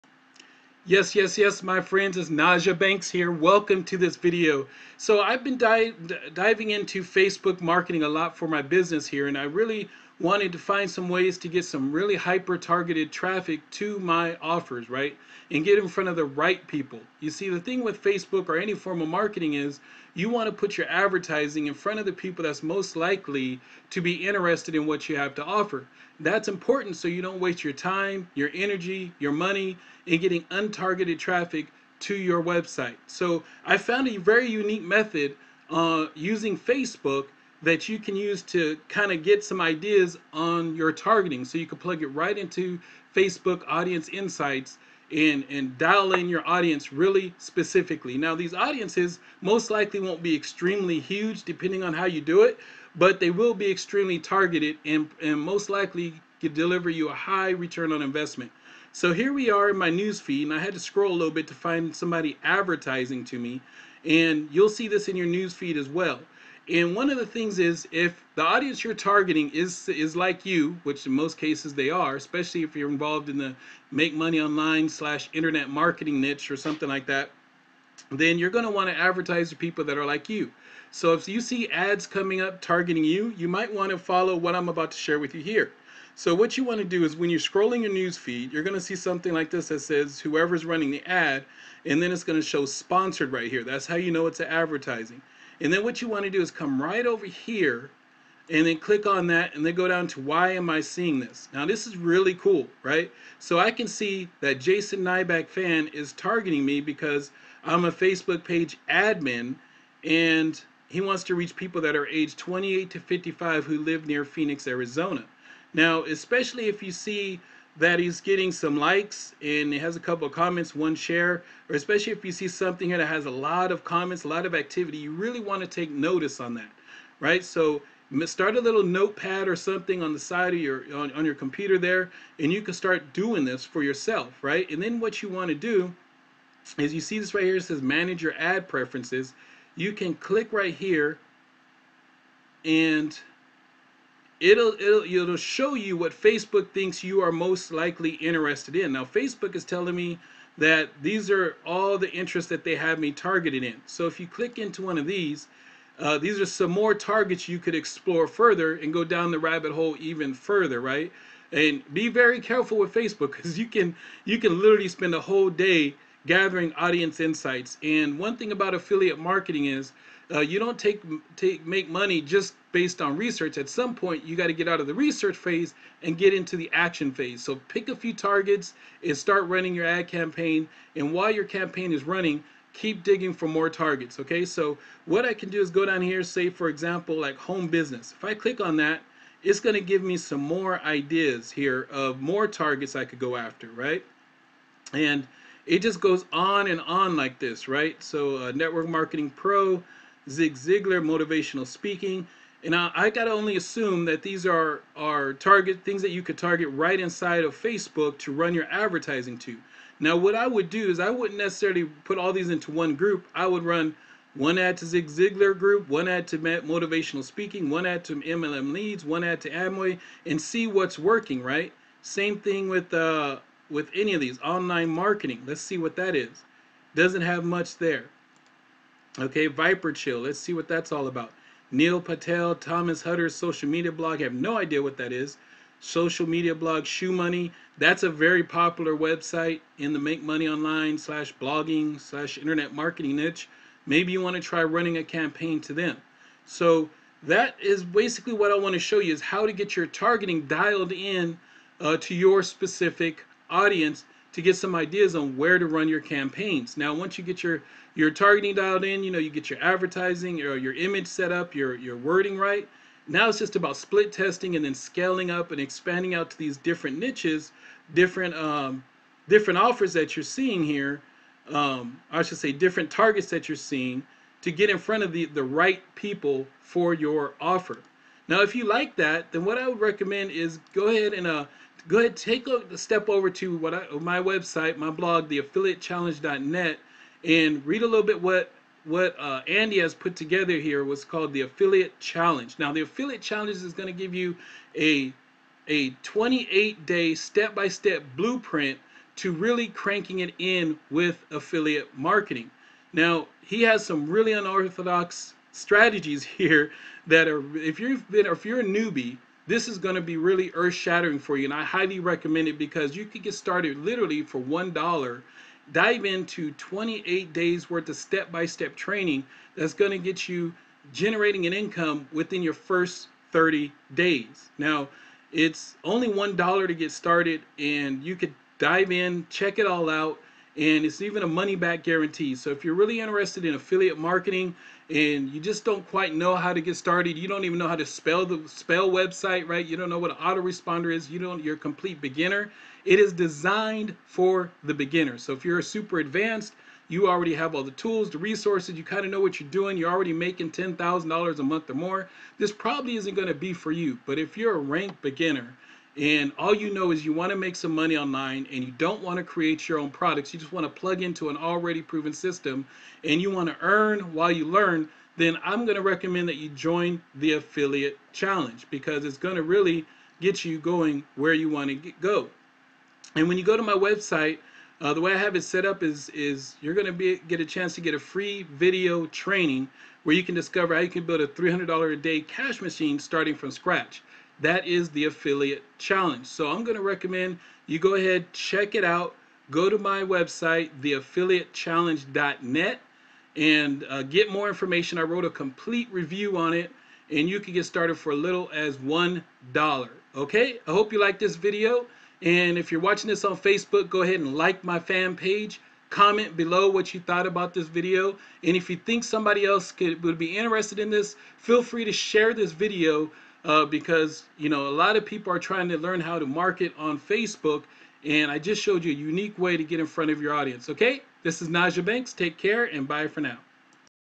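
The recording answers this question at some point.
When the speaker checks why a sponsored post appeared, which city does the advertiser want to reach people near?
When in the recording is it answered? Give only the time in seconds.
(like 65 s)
114 s.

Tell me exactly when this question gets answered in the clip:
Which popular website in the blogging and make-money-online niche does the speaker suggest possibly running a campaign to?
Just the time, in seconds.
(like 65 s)
236 s.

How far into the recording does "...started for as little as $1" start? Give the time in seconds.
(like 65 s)
397 s.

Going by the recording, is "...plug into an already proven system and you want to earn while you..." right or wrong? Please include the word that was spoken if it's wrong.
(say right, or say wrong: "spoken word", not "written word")
right.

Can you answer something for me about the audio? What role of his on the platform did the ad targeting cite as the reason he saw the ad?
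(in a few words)
Facebook page admin.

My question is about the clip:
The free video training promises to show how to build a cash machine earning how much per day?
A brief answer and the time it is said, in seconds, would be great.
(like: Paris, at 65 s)
$300, at 381 s.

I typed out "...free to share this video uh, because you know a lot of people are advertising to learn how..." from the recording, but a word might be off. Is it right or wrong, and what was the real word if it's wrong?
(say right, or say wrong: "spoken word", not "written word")
wrong: "trying", not "advertising".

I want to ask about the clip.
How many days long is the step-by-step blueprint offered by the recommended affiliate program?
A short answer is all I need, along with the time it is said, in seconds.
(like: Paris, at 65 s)
28, at 296 s.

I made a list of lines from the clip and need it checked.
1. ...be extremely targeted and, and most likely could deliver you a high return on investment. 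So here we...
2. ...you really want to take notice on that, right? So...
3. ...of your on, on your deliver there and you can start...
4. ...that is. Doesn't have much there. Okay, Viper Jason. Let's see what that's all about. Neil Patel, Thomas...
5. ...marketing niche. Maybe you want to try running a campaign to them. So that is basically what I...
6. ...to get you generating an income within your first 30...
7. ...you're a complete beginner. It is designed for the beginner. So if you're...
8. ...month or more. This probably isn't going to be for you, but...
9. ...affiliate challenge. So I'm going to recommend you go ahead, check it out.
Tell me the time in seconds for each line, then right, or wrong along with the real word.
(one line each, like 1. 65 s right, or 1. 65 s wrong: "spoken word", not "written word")
1. 53 s right
2. 124 s right
3. 130 s wrong: "computer", not "deliver"
4. 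225 s wrong: "Chill", not "Jason"
5. 242 s right
6. 319 s right
7. 341 s right
8. 351 s right
9. 385 s right.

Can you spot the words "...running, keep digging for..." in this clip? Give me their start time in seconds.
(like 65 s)
182 s.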